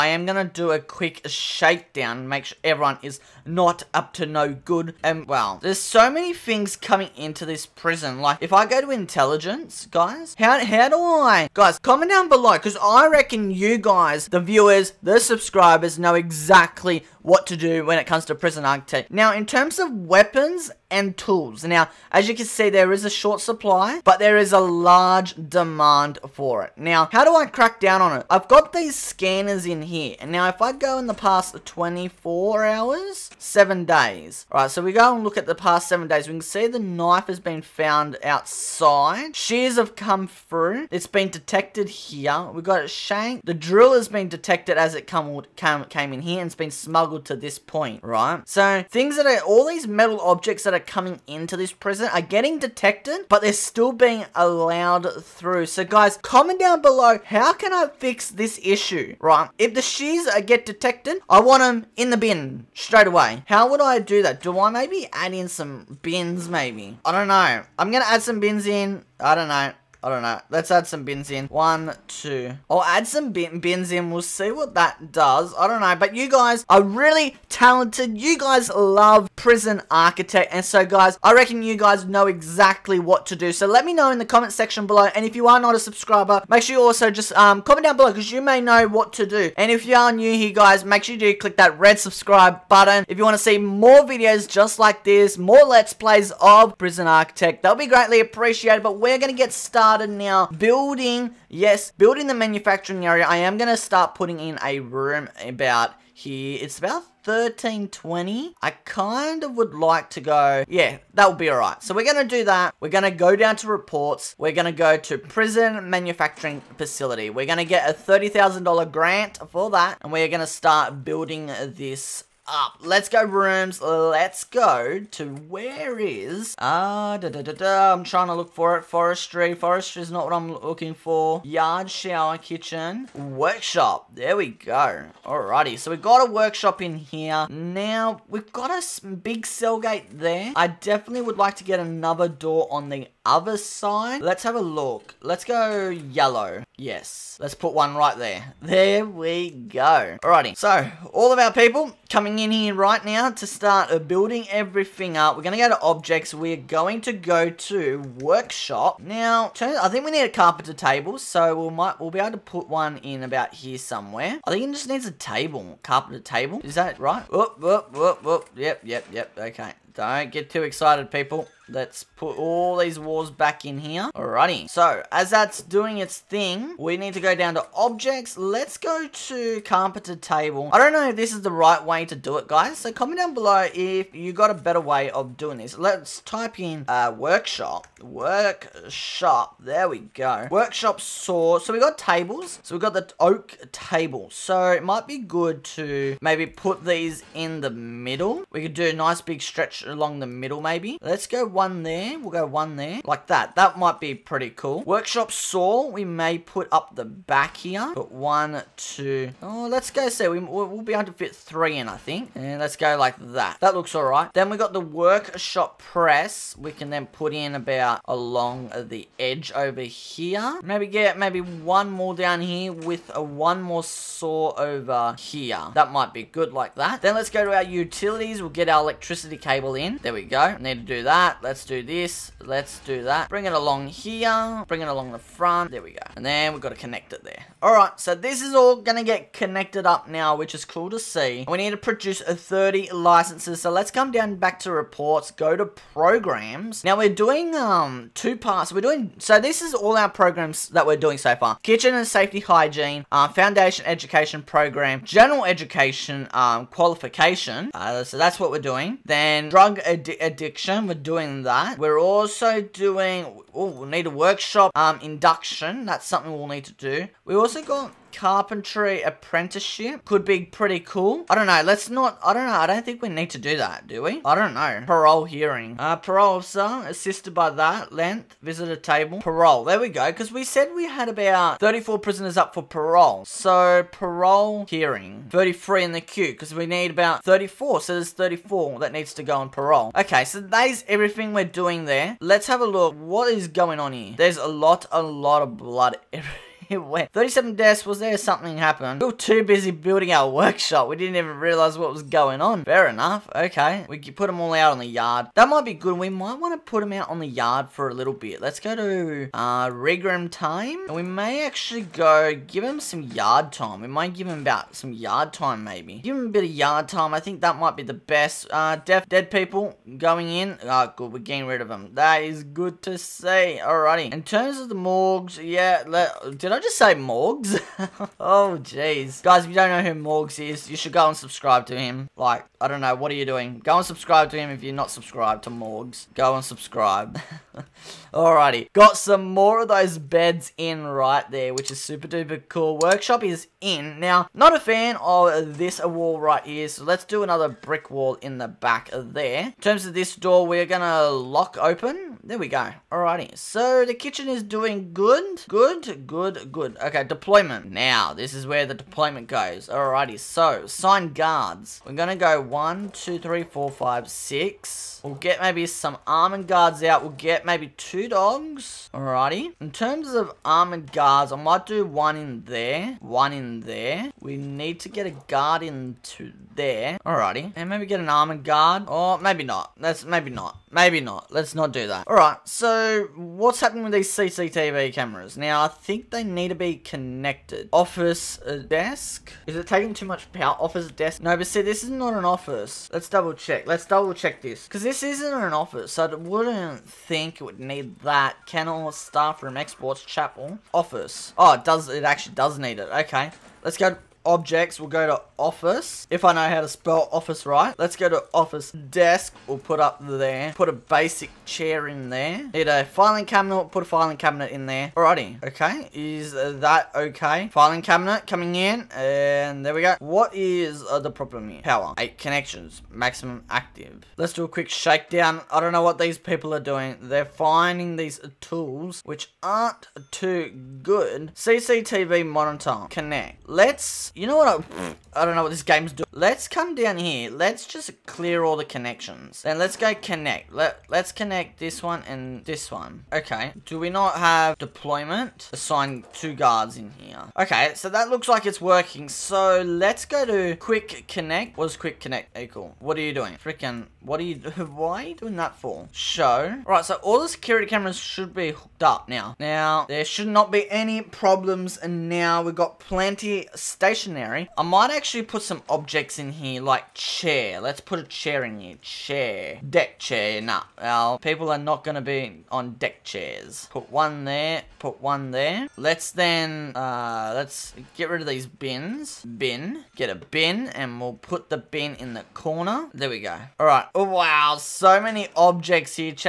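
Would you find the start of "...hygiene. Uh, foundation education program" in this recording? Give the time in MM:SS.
04:12.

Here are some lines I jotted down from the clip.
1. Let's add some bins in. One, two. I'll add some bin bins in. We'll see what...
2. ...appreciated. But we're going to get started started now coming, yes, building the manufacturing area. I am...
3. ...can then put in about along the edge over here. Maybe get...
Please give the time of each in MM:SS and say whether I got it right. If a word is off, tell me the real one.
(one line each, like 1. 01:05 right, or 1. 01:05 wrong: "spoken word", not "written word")
1. 01:10 right
2. 01:38 wrong: "building", not "coming"
3. 03:36 right.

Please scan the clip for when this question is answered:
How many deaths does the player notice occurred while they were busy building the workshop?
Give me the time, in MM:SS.
04:57.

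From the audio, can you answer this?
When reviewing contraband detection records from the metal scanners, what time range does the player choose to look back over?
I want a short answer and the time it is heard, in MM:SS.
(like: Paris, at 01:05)
7 days, at 00:35.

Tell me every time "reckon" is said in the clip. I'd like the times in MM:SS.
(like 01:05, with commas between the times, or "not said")
00:13, 01:21.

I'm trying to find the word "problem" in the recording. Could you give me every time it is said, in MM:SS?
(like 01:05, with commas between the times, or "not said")
07:01, 07:41.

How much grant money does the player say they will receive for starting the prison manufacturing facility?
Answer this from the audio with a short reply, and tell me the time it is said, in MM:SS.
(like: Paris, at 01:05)
$30,000, at 01:57.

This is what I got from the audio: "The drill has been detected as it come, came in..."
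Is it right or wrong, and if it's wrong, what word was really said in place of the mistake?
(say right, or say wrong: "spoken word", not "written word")
right.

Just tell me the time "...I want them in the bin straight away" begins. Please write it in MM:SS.
01:01.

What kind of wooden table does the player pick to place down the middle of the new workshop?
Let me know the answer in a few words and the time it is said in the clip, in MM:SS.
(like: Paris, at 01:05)
oak table, at 03:13.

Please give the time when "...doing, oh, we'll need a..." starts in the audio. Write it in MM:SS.
04:22.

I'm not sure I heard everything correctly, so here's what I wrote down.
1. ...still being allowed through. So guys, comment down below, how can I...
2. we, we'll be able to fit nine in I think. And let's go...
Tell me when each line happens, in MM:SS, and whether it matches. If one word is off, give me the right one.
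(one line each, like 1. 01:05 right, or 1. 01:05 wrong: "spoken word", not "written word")
1. 00:53 right
2. 03:30 wrong: "three", not "nine".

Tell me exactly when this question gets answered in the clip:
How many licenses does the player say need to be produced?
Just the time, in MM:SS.
04:02.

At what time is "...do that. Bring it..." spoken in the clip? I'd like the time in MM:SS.
03:52.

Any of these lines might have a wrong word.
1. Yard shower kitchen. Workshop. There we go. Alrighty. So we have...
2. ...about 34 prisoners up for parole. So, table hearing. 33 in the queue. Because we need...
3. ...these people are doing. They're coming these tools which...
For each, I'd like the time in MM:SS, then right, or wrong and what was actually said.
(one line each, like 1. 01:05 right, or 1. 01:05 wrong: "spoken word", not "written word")
1. 02:11 right
2. 04:41 wrong: "parole", not "table"
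3. 07:05 wrong: "finding", not "coming".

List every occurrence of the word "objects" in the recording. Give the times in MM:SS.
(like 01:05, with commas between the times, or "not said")
00:50, 02:35, 02:57, 06:44, 07:45, 08:05.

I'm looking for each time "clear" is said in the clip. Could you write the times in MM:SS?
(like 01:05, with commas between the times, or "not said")
07:18.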